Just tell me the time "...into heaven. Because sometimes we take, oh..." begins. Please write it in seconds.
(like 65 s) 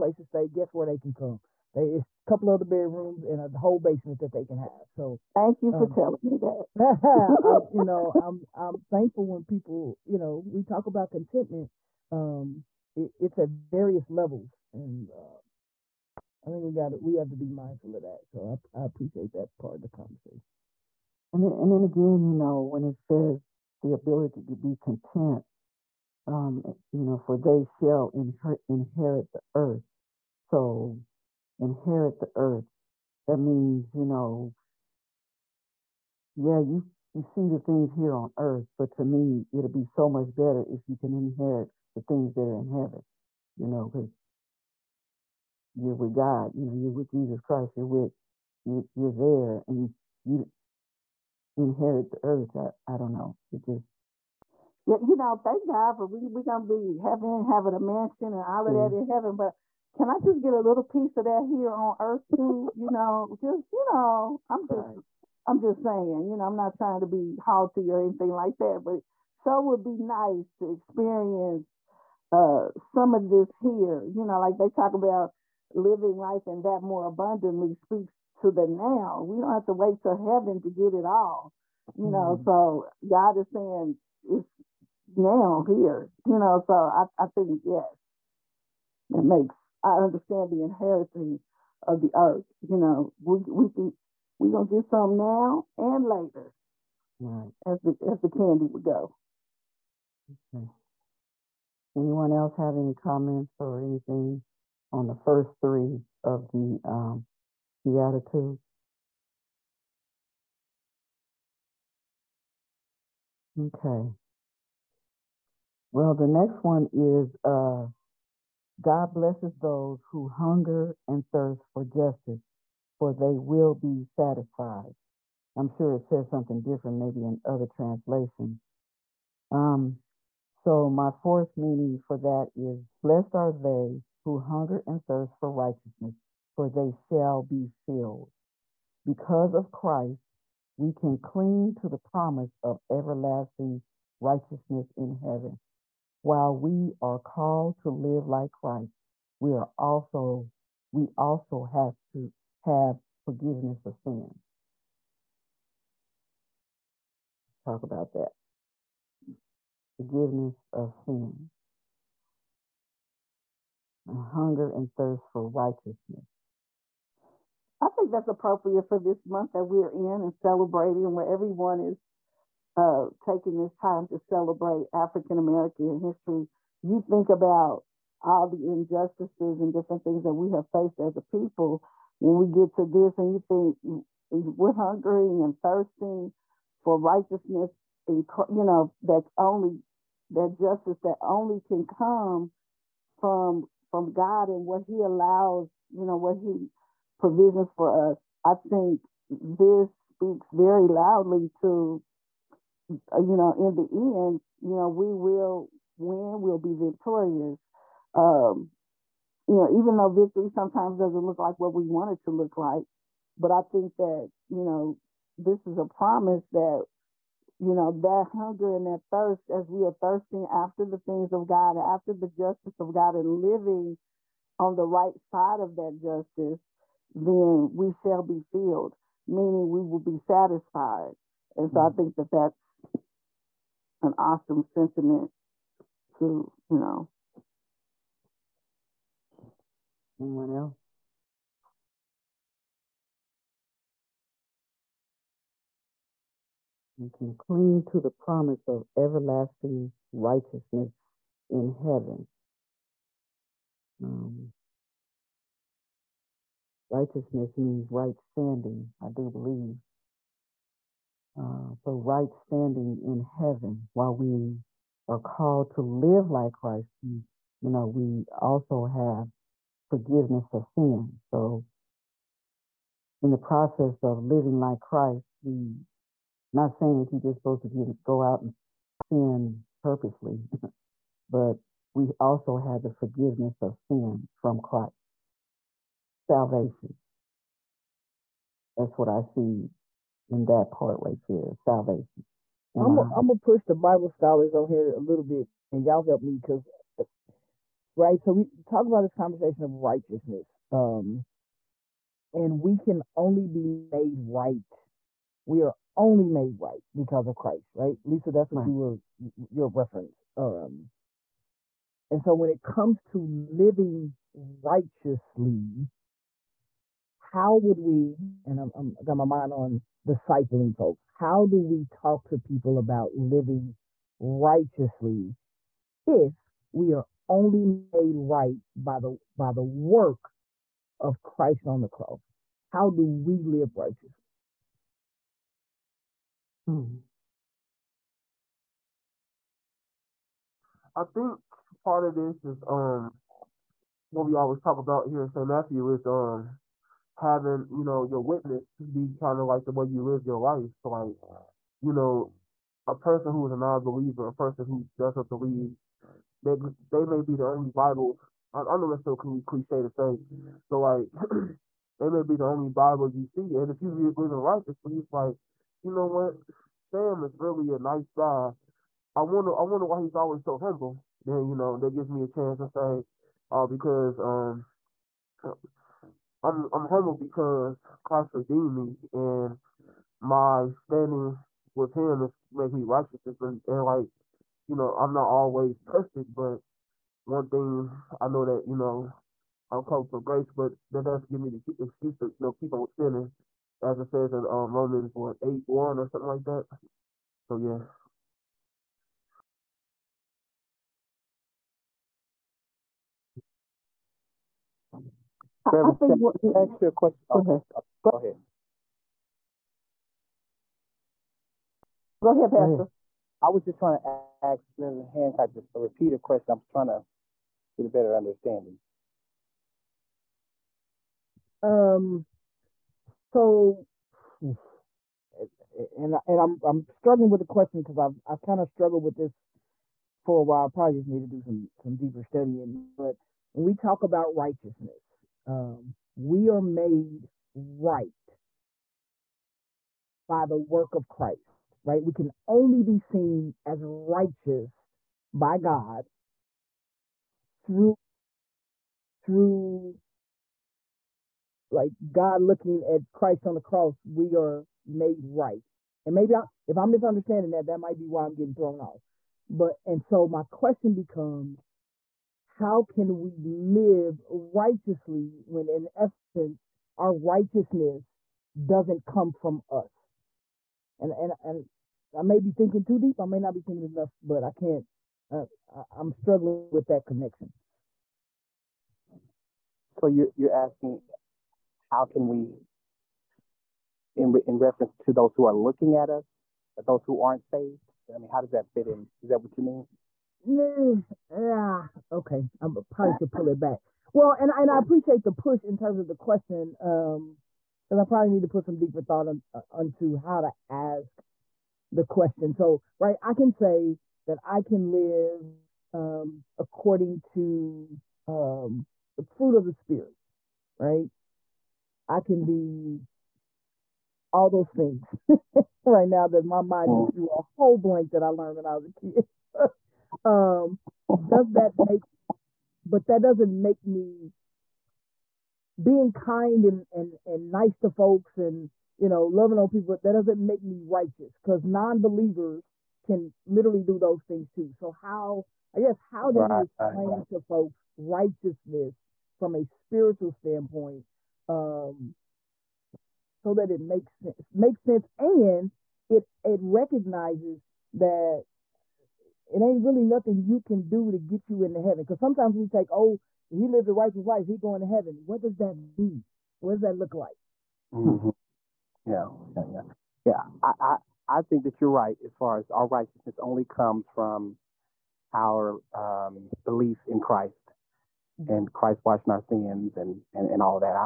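551 s.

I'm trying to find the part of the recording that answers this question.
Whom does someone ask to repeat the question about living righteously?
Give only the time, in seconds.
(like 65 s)
414 s.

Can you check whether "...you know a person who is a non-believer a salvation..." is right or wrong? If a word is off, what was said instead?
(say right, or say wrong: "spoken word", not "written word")
wrong: "person", not "salvation".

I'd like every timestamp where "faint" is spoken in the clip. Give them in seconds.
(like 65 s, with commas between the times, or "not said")
not said.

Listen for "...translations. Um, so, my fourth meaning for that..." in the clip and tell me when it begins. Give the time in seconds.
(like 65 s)
127 s.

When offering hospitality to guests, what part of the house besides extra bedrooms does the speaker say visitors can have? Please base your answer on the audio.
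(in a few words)
a whole basement.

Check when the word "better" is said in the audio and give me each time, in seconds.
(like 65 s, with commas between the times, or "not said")
40 s, 417 s.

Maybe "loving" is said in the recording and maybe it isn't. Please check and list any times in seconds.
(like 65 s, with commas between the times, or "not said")
529 s.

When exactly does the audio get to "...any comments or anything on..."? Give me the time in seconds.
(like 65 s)
102 s.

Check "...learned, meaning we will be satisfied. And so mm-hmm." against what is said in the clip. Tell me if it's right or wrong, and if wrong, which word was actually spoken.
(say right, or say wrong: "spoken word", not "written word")
wrong: "filled", not "learned".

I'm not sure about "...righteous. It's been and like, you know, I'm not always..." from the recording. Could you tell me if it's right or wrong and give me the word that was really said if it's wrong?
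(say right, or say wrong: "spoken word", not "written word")
right.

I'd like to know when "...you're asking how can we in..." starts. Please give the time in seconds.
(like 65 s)
480 s.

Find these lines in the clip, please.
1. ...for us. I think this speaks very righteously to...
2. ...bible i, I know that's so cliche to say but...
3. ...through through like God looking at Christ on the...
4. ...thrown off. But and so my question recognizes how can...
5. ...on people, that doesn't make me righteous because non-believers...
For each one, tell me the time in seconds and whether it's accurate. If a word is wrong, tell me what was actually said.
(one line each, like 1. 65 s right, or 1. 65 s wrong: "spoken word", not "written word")
1. 197 s wrong: "loudly", not "righteously"
2. 357 s right
3. 447 s right
4. 458 s wrong: "becomes", not "recognizes"
5. 529 s right.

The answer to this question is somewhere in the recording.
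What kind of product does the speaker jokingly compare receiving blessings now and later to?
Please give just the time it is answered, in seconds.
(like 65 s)
98 s.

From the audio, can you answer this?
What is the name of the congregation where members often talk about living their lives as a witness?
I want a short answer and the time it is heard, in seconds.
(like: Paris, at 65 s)
St. Matthew, at 345 s.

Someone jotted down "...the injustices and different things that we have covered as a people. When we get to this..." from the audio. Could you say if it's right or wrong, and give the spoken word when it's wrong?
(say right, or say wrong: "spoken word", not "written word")
wrong: "faced", not "covered".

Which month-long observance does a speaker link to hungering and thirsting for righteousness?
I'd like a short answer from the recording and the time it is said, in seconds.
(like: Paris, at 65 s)
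African American history, at 174 s.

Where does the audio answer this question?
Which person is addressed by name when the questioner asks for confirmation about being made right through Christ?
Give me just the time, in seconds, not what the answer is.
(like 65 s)
308 s.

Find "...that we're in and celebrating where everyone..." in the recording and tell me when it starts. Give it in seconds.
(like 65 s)
169 s.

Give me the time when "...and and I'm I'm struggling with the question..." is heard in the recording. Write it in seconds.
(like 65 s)
424 s.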